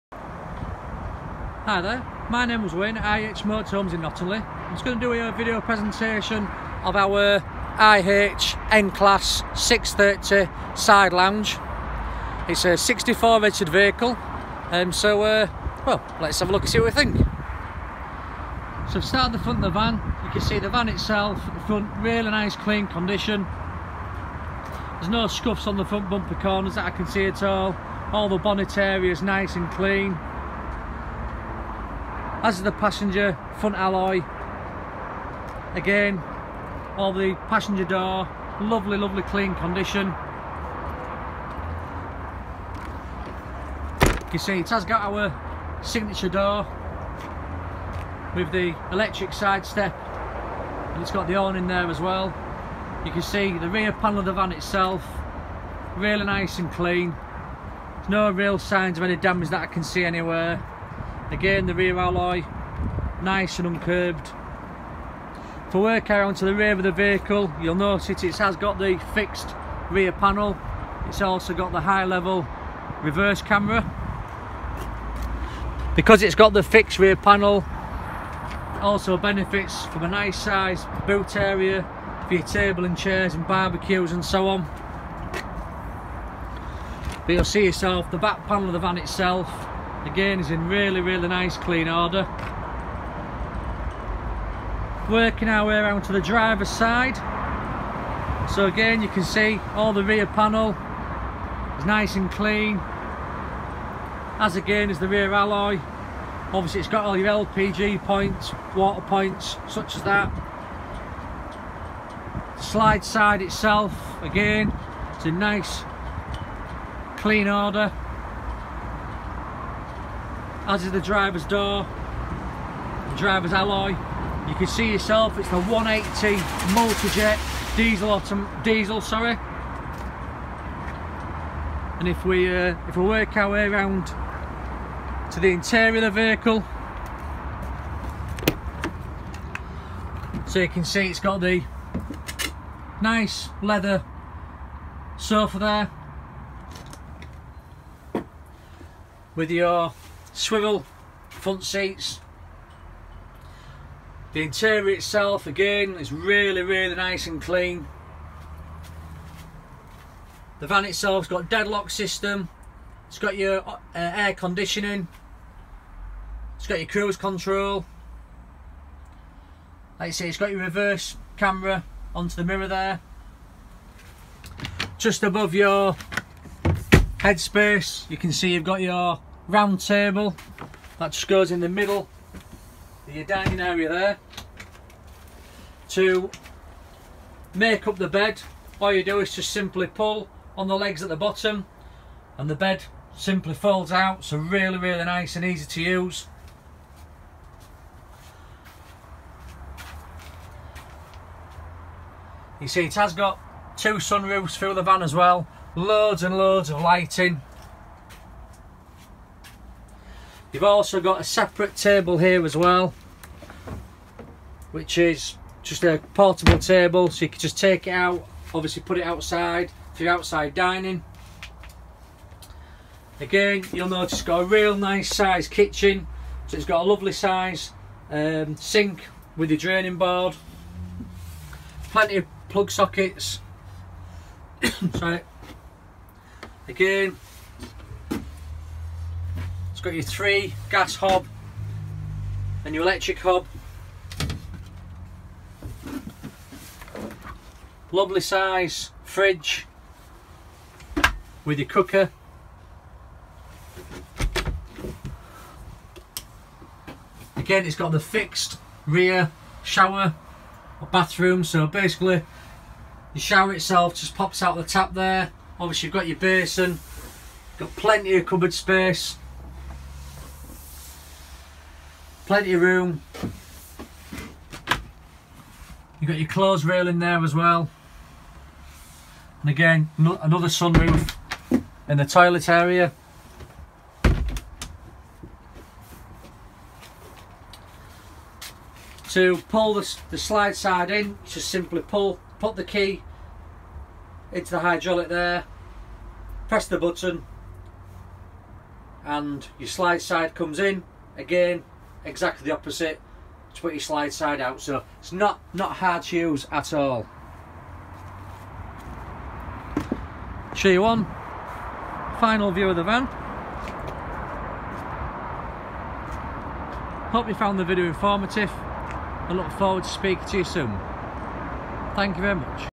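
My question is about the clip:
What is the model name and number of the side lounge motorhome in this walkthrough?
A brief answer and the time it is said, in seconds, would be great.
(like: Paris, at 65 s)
N-Class 630, at 8 s.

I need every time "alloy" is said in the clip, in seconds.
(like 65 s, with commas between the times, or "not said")
33 s, 61 s, 105 s, 123 s.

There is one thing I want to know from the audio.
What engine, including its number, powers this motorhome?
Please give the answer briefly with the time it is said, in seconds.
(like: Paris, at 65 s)
180 multi-jet diesel, at 125 s.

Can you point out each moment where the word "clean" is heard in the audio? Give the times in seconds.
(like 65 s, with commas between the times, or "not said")
22 s, 29 s, 39 s, 56 s, 91 s, 102 s, 117 s, 157 s.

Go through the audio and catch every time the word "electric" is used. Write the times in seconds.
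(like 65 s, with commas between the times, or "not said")
48 s, 242 s.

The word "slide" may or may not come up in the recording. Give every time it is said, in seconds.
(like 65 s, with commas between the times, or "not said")
112 s, 290 s, 299 s, 303 s.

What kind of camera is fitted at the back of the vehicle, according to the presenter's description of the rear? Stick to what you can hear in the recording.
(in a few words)
High level reverse camera.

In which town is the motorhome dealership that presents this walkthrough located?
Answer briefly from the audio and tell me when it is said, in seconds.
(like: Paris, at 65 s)
Knottingley, at 4 s.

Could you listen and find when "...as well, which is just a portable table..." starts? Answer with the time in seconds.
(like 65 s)
212 s.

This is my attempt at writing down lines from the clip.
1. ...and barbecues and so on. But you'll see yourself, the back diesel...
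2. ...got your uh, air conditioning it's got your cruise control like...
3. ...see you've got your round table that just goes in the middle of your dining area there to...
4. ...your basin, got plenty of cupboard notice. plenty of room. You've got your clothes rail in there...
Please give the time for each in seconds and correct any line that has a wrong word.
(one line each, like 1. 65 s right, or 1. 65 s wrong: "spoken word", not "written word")
1. 83 s wrong: "panel", not "diesel"
2. 163 s right
3. 178 s right
4. 266 s wrong: "space", not "notice".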